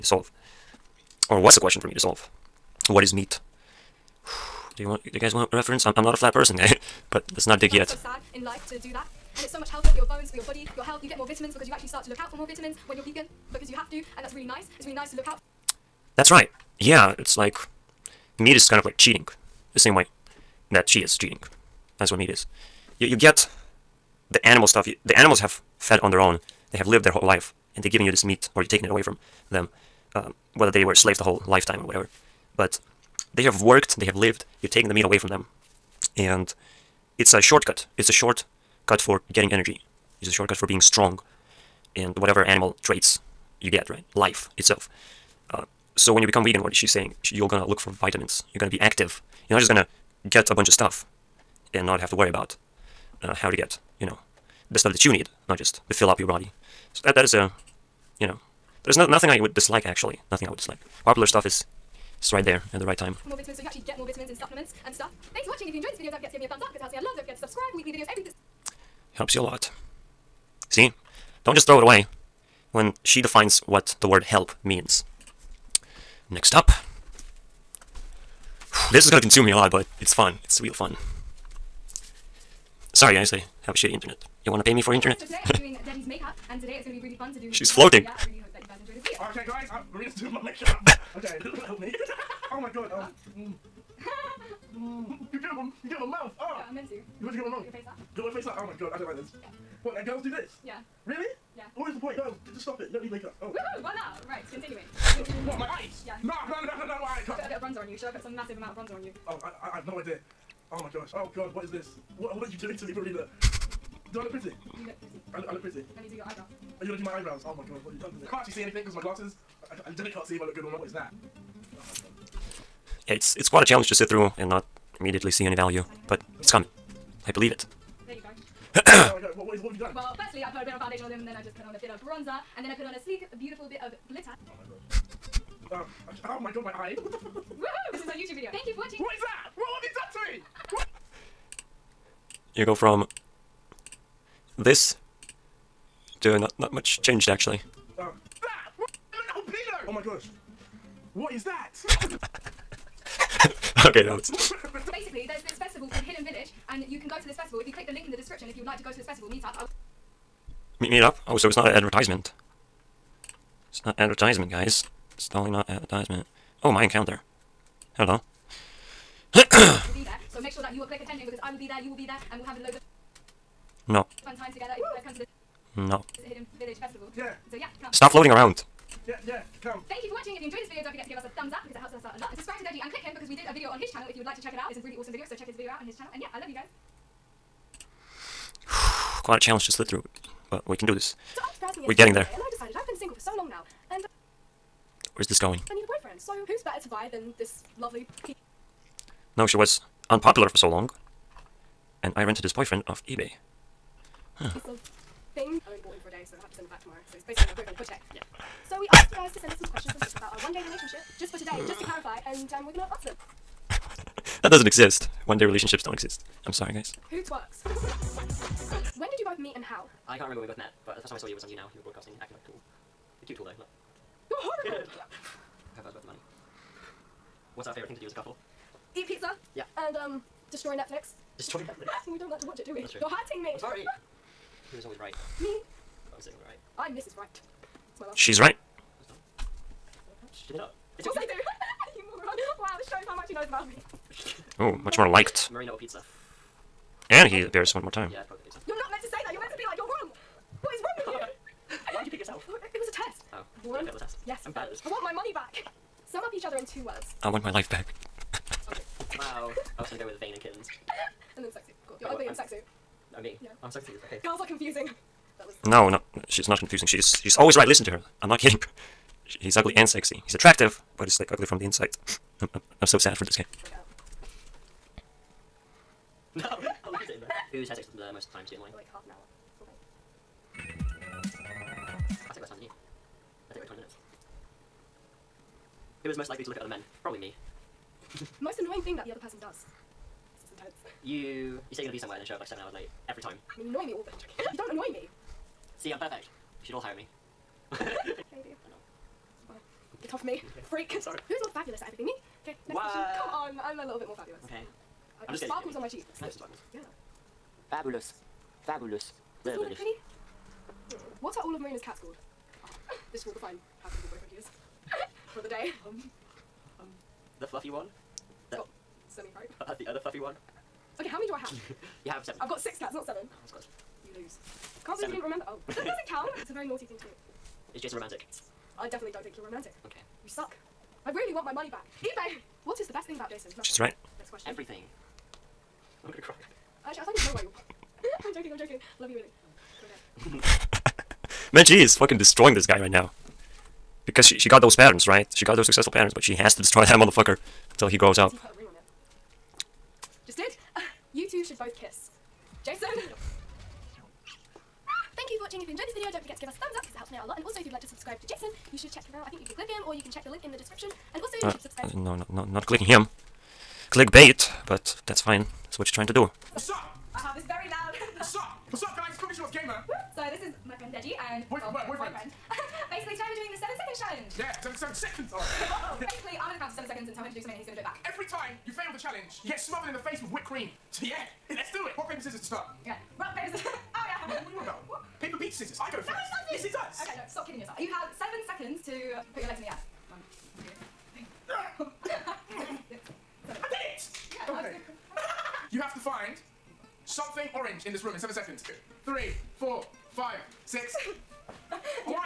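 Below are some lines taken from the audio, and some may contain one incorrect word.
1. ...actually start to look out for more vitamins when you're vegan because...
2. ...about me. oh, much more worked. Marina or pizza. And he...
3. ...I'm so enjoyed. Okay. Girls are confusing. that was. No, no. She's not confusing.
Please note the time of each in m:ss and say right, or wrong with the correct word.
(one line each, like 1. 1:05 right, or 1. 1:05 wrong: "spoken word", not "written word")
1. 0:11 right
2. 4:03 wrong: "liked", not "worked"
3. 4:23 wrong: "confused", not "enjoyed".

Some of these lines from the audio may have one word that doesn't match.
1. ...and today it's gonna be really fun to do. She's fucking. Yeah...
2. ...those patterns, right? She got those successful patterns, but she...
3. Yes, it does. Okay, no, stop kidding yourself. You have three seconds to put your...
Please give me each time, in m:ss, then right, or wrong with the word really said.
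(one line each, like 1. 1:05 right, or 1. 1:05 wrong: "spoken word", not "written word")
1. 1:26 wrong: "floating", not "fucking"
2. 5:44 right
3. 6:26 wrong: "seven", not "three".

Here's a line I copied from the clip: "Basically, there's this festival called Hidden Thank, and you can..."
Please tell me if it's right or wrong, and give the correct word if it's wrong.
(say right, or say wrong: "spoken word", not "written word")
wrong: "Village", not "Thank".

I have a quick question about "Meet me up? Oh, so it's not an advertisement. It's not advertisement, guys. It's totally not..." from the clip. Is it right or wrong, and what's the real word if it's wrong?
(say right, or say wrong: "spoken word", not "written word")
right.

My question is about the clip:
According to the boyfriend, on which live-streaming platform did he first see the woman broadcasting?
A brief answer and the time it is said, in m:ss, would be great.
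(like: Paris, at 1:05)
YouNow, at 3:41.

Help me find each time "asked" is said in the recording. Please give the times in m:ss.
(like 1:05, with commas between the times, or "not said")
3:28.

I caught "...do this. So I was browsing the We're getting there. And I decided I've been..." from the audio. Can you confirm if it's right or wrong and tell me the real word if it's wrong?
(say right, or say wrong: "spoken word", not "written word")
right.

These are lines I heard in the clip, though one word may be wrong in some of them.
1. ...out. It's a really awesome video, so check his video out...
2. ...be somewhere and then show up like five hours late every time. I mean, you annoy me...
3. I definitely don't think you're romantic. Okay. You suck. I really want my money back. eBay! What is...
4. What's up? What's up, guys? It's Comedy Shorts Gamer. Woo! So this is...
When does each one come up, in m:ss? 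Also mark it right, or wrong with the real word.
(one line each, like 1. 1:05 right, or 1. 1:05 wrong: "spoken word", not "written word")
1. 3:04 right
2. 4:51 wrong: "seven", not "five"
3. 5:28 right
4. 6:08 right.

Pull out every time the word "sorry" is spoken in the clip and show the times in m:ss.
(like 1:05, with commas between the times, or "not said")
1:22, 3:36, 3:53, 5:01.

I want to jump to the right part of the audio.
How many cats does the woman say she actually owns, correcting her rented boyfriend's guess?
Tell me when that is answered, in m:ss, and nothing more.
5:22.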